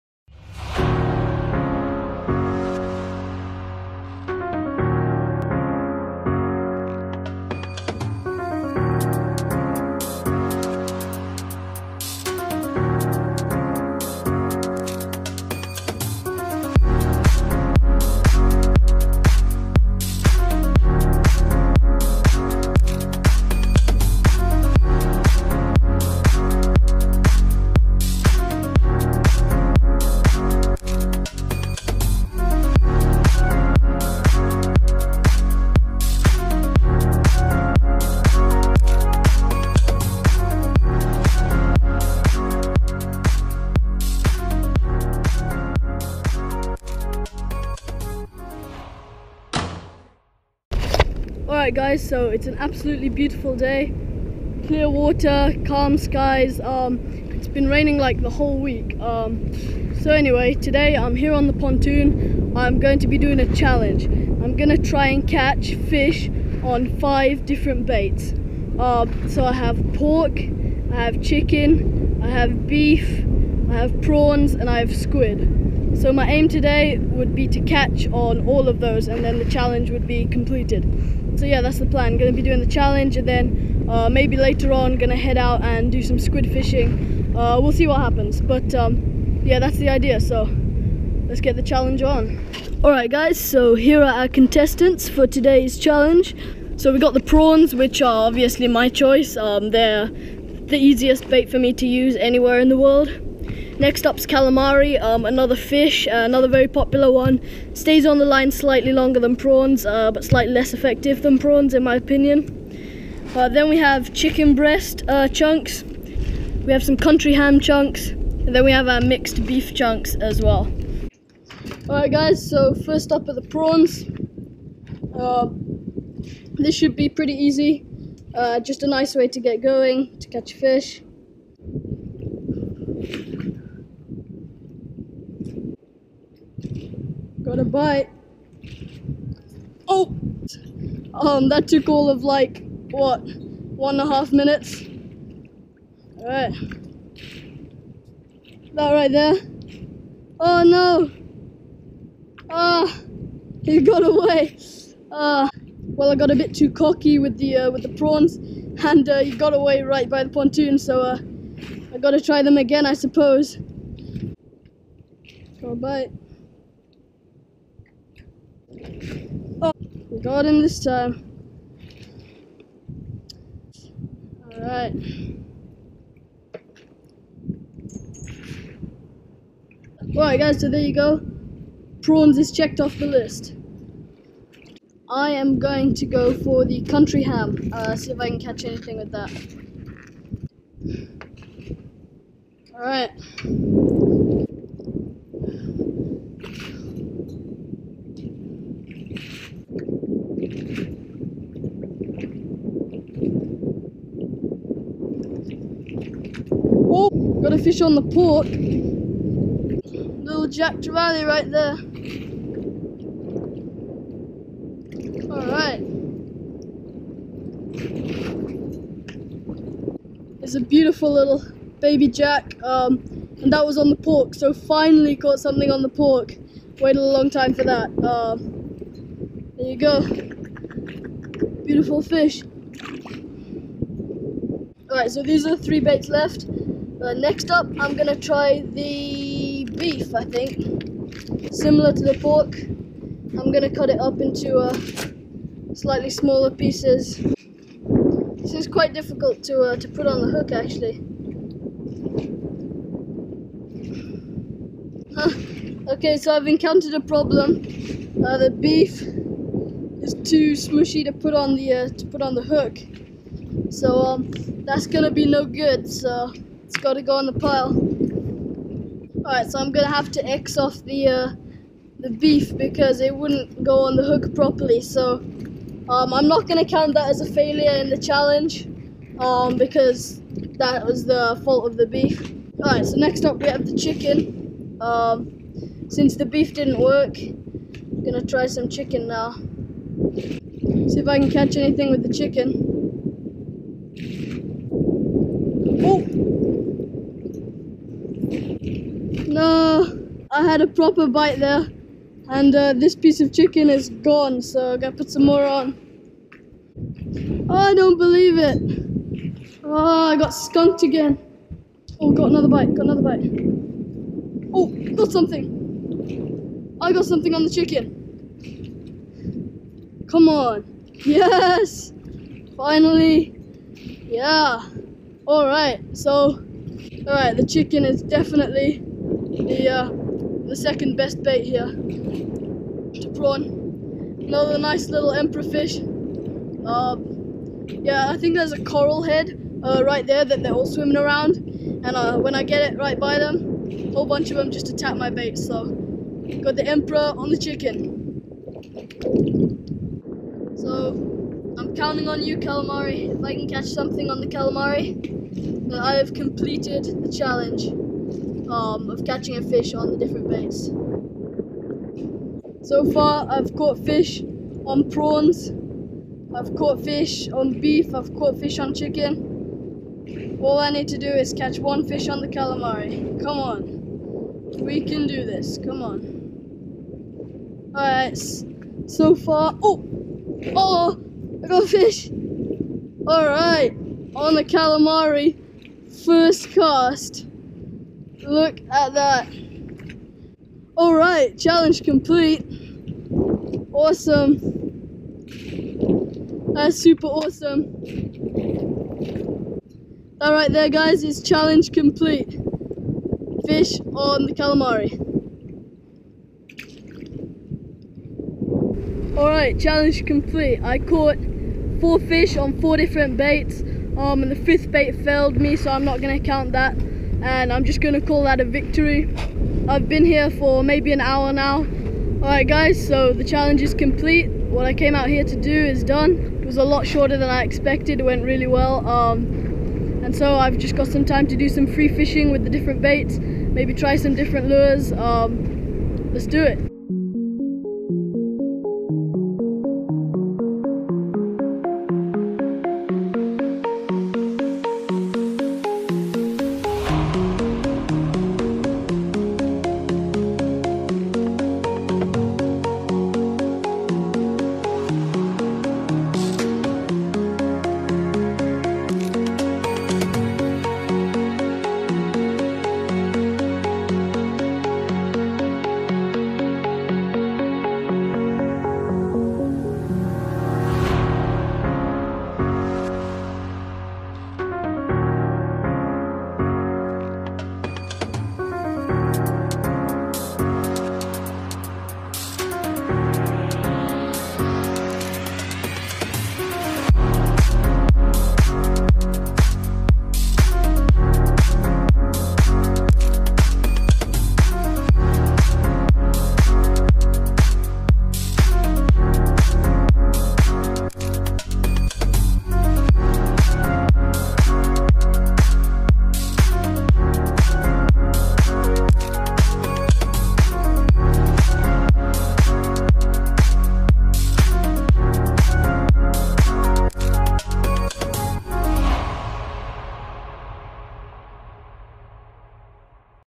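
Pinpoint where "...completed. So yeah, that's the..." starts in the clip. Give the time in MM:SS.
01:20.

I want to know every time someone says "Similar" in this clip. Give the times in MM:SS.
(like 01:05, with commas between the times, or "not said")
04:01.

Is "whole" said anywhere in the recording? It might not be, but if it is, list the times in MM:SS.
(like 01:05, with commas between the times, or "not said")
00:58, 05:43.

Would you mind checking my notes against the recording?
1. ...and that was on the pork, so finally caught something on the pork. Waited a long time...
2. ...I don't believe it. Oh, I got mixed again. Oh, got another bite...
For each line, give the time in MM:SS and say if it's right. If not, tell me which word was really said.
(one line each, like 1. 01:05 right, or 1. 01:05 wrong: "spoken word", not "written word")
1. 03:43 right
2. 05:07 wrong: "skunked", not "mixed".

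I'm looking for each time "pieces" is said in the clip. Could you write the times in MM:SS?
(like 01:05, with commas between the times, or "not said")
04:06, 05:02.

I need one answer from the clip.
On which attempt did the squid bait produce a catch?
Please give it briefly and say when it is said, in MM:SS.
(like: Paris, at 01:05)
First cast, at 06:26.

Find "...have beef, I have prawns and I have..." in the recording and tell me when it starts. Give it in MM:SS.
01:12.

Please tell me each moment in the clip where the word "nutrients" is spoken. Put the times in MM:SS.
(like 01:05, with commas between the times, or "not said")
not said.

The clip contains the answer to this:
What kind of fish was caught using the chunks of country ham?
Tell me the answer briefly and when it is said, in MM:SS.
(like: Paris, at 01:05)
Jack Trevally, at 03:30.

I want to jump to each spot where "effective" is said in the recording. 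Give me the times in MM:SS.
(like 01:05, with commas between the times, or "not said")
01:50.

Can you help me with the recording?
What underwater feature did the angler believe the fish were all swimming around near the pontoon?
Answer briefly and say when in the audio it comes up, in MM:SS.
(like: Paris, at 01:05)
Coral head, at 05:38.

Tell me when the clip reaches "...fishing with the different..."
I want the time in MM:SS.
07:11.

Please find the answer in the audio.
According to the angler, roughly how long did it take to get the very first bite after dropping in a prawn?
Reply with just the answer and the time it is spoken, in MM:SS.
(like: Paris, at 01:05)
1.5 minutes, at 02:23.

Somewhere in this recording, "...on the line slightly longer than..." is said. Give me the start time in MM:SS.
01:48.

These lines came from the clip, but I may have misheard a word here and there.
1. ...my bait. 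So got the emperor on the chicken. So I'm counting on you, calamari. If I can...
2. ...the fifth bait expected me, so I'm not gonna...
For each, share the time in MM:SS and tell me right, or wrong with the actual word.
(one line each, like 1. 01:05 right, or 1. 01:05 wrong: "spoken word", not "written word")
1. 05:44 right
2. 06:54 wrong: "failed", not "expected".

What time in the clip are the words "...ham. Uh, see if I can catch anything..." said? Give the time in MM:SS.
03:07.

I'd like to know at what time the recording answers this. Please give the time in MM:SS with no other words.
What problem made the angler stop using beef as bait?
04:20.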